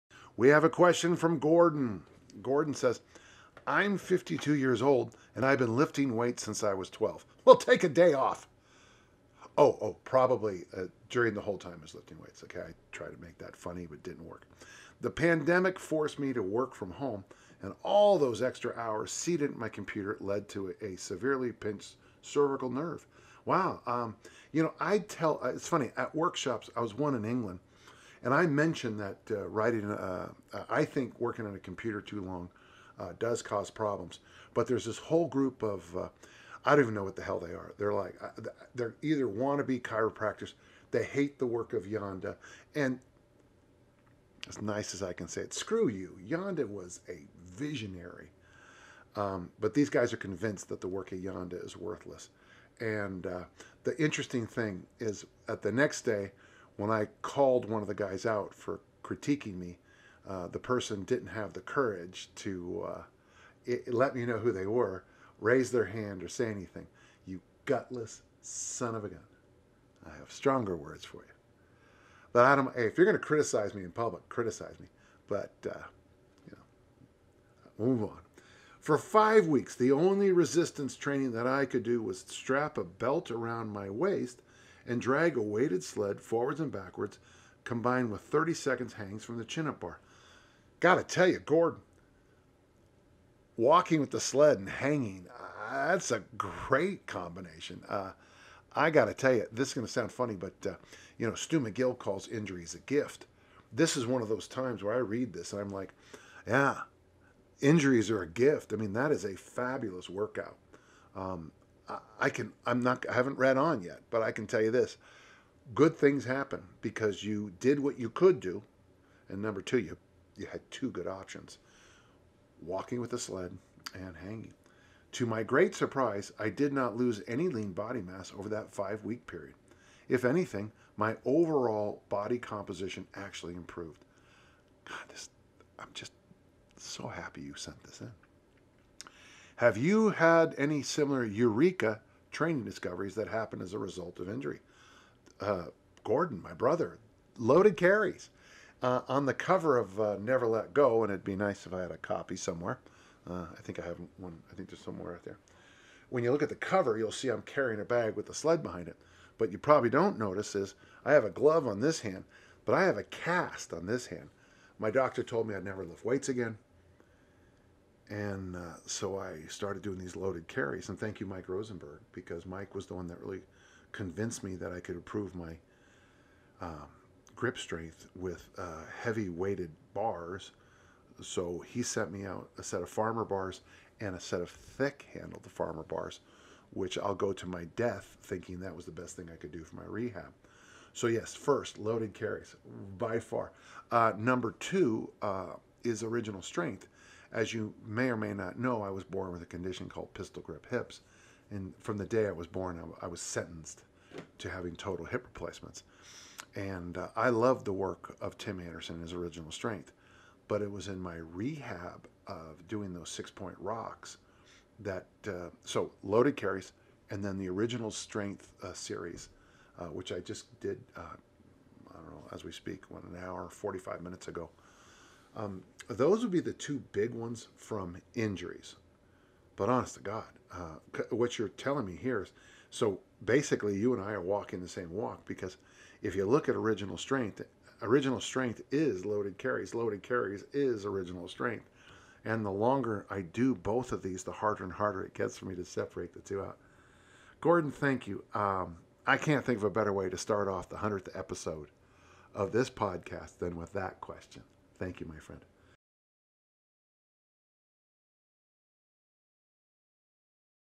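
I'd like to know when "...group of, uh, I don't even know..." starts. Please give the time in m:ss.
0:35.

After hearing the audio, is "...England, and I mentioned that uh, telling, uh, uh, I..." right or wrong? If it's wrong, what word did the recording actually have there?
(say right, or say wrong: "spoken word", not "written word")
wrong: "writing", not "telling".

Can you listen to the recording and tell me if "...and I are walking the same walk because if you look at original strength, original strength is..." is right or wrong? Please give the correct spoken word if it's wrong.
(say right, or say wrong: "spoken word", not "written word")
right.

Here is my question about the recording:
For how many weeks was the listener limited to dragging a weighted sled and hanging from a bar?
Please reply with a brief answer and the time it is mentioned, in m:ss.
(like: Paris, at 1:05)
5, at 1:18.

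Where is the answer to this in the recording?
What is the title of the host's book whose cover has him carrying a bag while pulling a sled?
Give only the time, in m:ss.
2:30.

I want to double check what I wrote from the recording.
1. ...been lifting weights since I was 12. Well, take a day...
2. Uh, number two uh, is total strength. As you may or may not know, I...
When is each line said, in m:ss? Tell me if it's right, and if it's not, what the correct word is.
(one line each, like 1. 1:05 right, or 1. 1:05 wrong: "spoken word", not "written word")
1. 0:05 right
2. 3:13 wrong: "original", not "total".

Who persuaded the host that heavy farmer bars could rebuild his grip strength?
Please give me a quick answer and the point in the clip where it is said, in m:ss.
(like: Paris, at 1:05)
Mike Rosenberg, at 2:51.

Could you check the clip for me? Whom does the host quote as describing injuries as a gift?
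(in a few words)
Stu McGill.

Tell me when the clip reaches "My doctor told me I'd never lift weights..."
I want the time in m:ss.
2:44.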